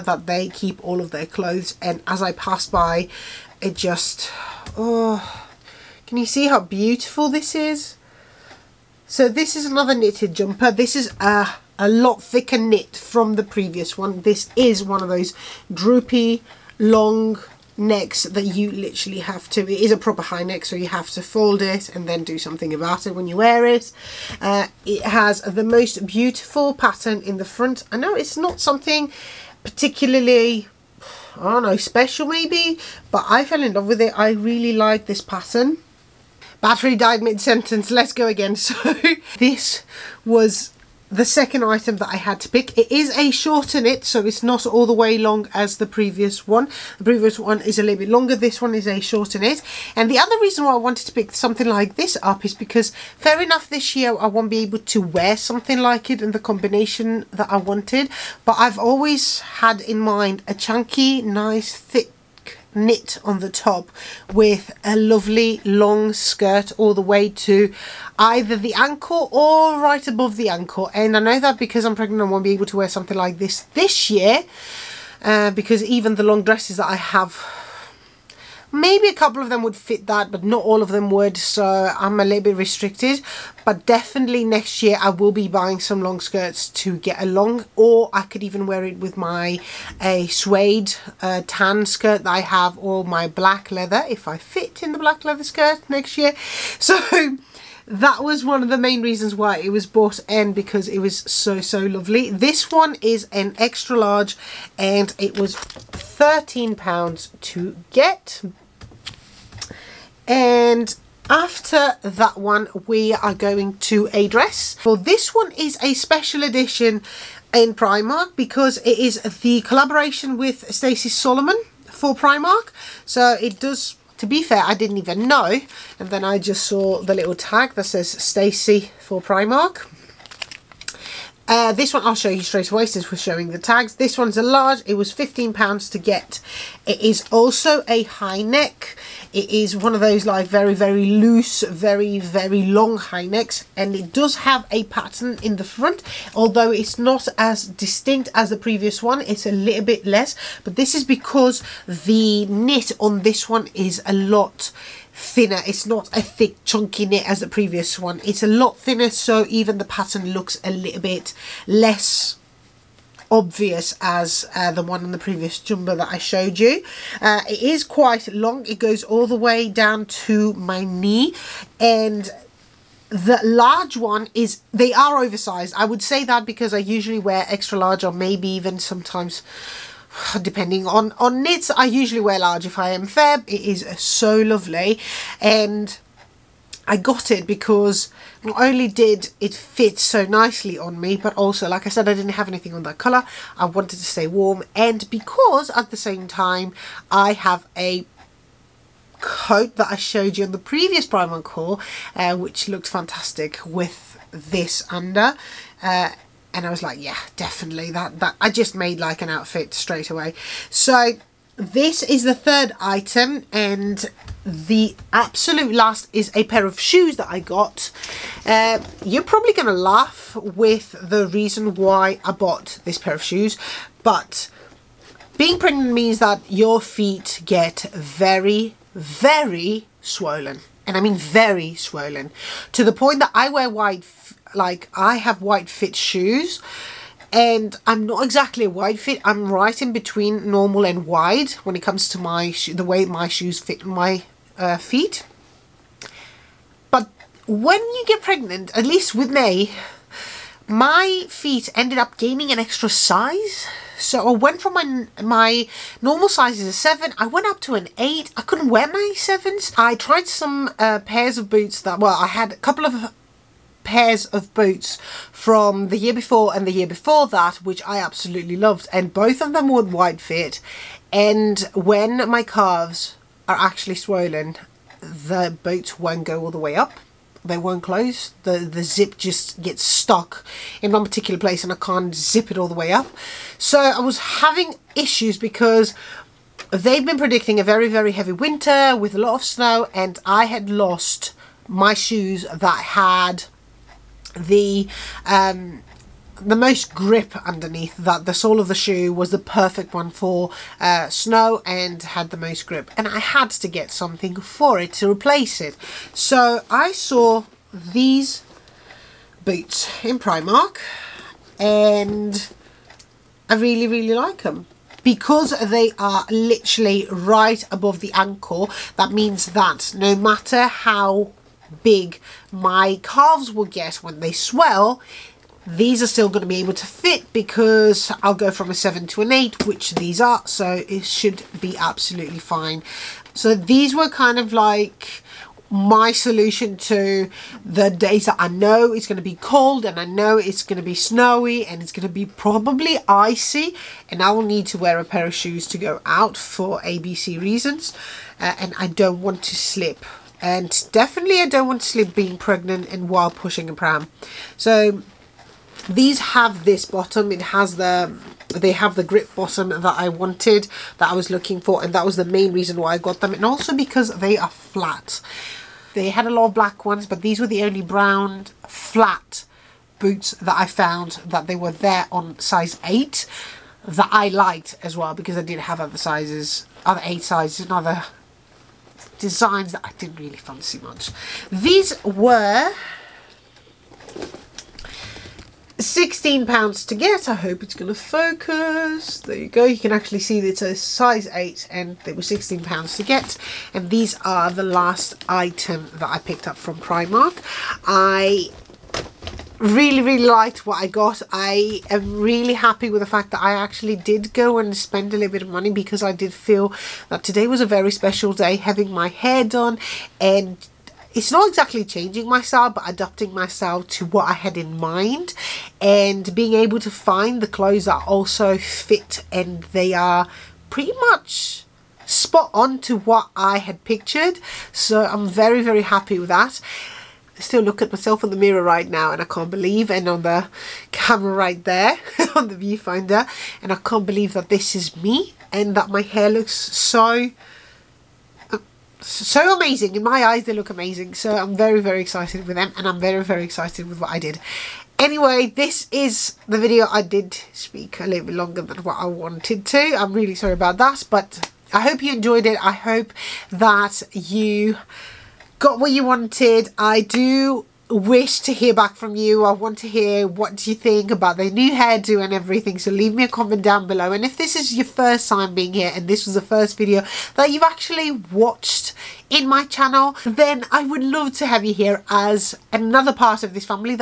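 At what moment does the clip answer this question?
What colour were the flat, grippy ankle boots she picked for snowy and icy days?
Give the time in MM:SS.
06:07.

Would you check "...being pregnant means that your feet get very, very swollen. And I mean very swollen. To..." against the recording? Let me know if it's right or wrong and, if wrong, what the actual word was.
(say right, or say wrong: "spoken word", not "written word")
right.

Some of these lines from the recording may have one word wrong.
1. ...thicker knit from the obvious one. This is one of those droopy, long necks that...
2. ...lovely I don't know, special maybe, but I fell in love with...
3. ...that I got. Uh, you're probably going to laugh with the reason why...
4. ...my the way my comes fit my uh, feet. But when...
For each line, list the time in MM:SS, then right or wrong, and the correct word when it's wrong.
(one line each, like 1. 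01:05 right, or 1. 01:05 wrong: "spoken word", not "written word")
1. 00:12 wrong: "previous", not "obvious"
2. 00:29 wrong: "particularly", not "lovely"
3. 03:37 right
4. 04:02 wrong: "shoes", not "comes".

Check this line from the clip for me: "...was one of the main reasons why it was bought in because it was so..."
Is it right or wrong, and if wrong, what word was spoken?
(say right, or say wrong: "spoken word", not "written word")
right.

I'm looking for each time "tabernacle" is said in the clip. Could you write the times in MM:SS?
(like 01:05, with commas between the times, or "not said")
not said.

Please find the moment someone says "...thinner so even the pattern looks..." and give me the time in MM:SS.
02:38.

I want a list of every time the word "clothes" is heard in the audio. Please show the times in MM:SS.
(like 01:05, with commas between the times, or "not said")
00:01, 06:57.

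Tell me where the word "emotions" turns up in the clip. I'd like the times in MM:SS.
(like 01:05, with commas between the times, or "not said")
not said.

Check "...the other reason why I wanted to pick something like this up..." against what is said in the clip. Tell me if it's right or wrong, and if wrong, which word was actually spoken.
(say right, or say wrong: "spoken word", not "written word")
right.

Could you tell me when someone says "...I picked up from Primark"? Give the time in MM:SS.
06:36.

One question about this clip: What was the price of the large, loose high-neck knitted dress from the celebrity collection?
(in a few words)
£15.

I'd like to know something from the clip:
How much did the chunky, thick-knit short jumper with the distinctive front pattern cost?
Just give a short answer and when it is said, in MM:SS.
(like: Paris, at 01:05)
£13, at 01:45.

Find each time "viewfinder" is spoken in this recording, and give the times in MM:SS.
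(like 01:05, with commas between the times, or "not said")
07:12.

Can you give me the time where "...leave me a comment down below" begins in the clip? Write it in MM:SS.
07:42.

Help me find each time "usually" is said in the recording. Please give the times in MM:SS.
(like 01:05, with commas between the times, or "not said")
02:56, 03:01.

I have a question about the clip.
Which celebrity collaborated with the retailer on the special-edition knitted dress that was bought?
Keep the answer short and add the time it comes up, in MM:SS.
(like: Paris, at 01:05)
Stacey Solomon, at 02:00.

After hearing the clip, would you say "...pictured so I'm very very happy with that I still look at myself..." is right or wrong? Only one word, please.
right.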